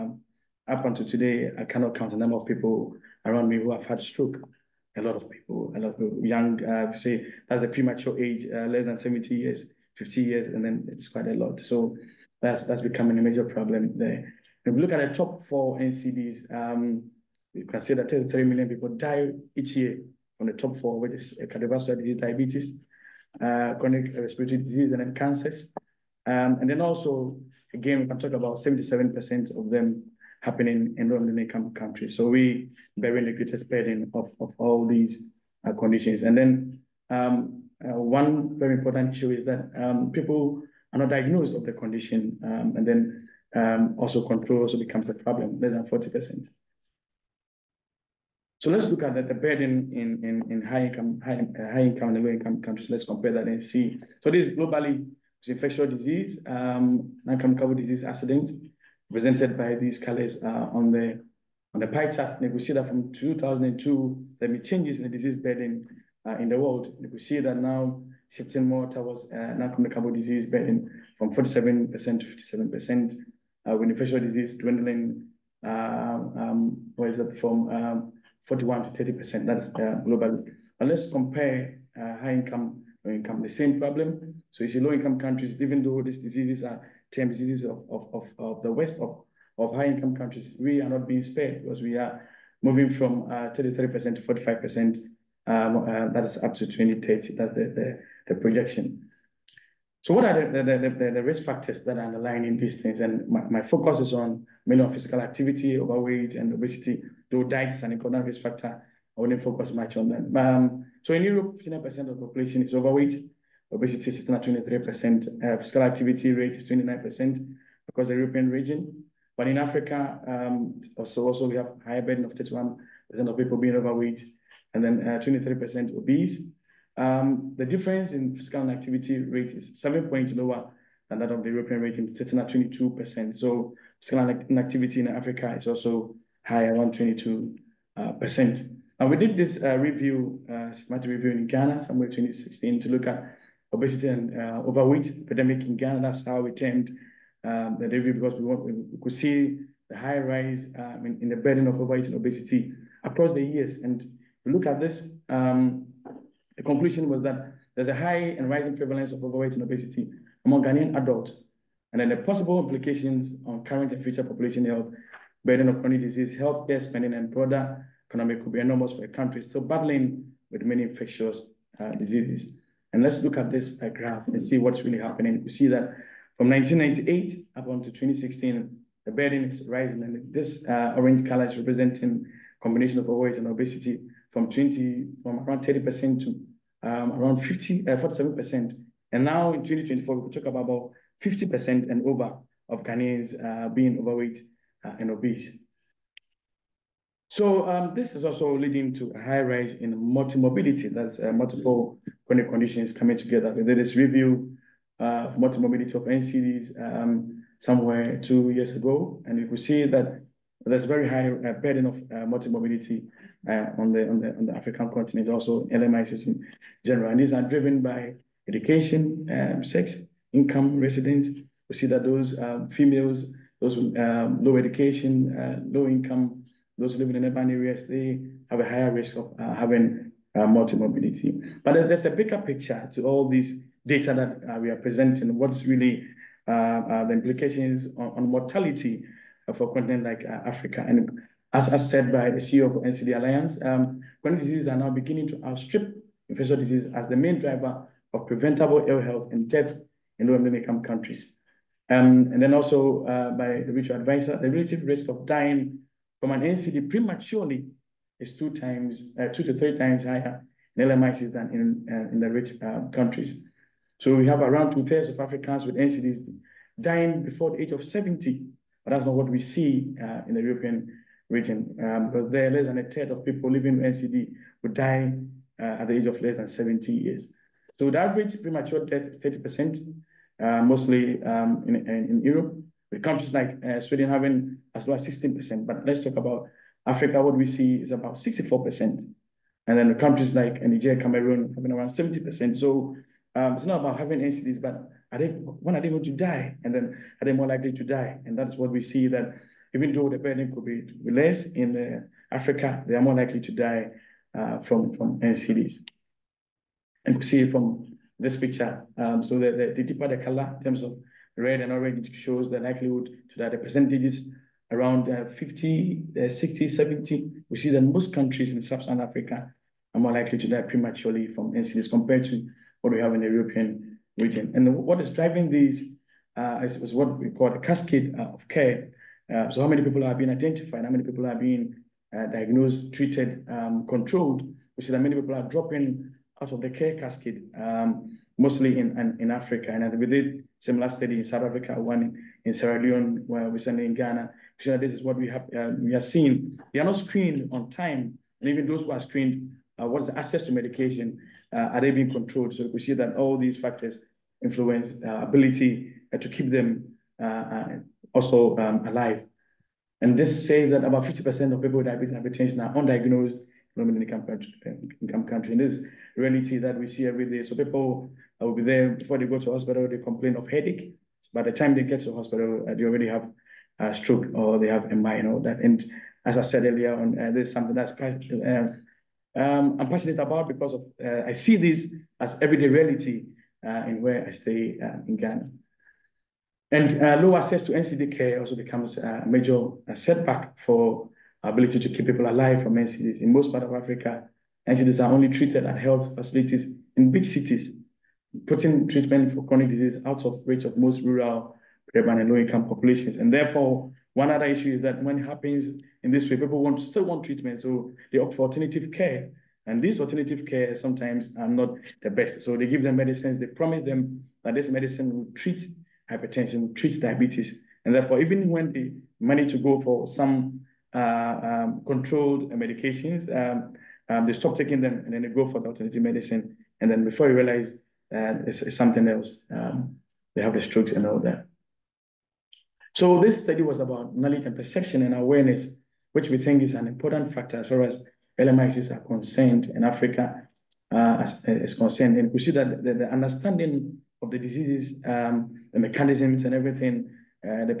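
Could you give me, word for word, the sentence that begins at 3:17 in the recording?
So um, this is also leading to a high rise in multimorbidity.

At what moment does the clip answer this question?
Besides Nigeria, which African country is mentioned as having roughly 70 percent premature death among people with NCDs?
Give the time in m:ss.
4:51.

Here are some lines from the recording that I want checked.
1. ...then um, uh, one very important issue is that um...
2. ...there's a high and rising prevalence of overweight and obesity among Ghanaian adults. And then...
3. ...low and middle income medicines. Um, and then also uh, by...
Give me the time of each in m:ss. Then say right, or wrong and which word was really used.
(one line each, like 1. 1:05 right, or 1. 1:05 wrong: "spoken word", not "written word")
1. 0:36 right
2. 2:37 right
3. 4:10 wrong: "countries", not "medicines".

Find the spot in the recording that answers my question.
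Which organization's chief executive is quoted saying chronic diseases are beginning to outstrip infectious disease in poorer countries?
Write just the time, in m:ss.
4:02.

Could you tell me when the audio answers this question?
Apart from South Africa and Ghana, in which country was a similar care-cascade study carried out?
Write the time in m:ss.
5:42.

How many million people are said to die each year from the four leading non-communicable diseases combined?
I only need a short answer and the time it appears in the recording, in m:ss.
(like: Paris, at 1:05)
33 million, at 0:18.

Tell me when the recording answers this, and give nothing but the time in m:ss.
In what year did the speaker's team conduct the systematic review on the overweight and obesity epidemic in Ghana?
2:21.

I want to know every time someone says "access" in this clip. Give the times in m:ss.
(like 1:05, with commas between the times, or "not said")
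5:50, 6:27.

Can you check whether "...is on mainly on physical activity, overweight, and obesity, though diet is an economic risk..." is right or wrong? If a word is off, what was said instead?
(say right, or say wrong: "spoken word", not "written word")
right.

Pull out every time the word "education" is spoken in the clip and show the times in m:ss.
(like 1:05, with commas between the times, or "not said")
3:38, 3:44.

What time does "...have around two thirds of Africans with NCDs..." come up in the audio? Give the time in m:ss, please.
4:24.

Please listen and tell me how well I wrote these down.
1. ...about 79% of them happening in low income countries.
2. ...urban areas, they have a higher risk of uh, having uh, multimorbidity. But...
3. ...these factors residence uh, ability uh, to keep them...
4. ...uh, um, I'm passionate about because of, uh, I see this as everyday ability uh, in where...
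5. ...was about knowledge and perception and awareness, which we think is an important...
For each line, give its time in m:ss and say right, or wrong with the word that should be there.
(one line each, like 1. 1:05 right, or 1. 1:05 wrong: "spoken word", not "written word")
1. 0:28 wrong: "77", not "79"
2. 3:47 right
3. 5:53 wrong: "influence", not "residence"
4. 6:17 wrong: "reality", not "ability"
5. 7:13 right.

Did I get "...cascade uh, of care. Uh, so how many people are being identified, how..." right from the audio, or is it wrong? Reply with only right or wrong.
right.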